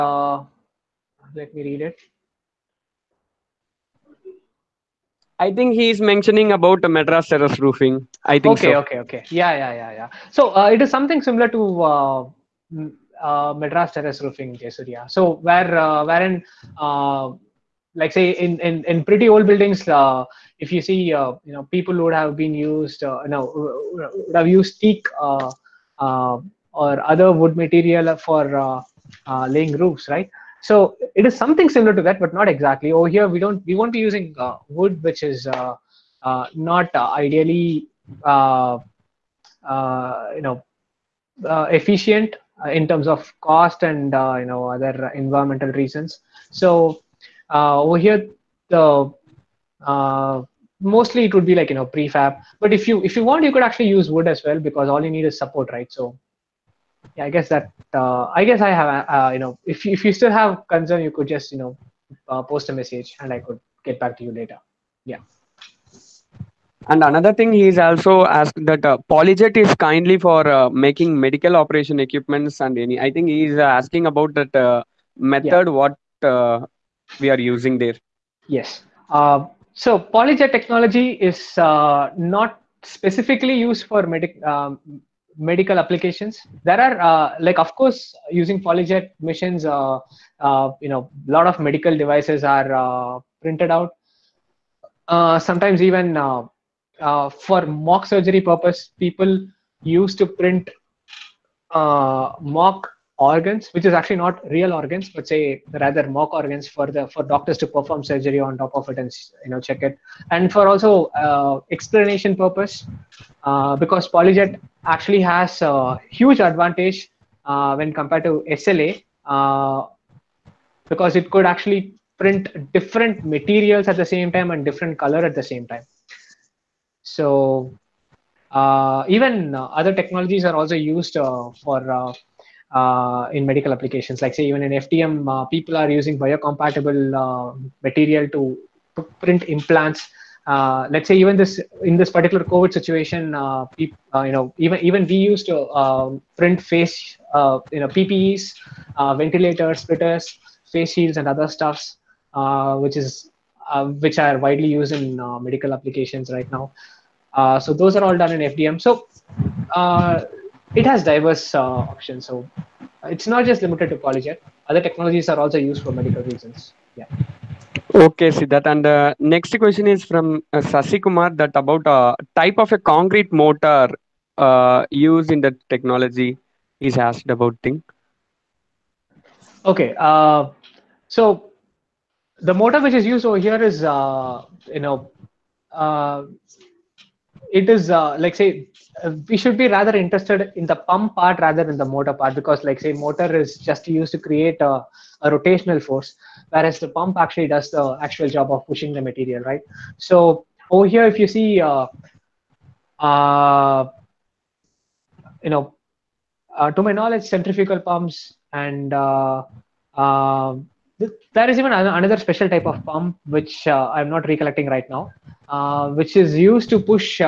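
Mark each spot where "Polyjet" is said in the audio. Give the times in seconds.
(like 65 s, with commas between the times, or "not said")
69 s, 79 s, 88 s, 114 s, 163 s.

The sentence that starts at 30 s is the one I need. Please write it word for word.
So it is something similar to that, but not exactly.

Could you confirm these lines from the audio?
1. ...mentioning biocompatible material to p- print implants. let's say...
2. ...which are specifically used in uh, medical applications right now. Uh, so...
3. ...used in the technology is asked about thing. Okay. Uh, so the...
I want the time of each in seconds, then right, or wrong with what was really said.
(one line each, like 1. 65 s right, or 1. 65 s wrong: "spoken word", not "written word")
1. 135 s wrong: "using", not "mentioning"
2. 154 s wrong: "widely", not "specifically"
3. 174 s right.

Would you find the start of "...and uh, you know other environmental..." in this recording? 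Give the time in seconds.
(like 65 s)
43 s.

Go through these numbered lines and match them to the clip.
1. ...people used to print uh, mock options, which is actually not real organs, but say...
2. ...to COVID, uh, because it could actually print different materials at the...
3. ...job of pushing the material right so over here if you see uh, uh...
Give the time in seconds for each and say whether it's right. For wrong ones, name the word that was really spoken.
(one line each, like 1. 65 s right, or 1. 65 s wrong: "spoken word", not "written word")
1. 99 s wrong: "organs", not "options"
2. 118 s wrong: "SLA", not "COVID"
3. 198 s right.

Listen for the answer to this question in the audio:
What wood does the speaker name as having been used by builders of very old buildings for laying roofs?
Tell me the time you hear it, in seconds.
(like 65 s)
24 s.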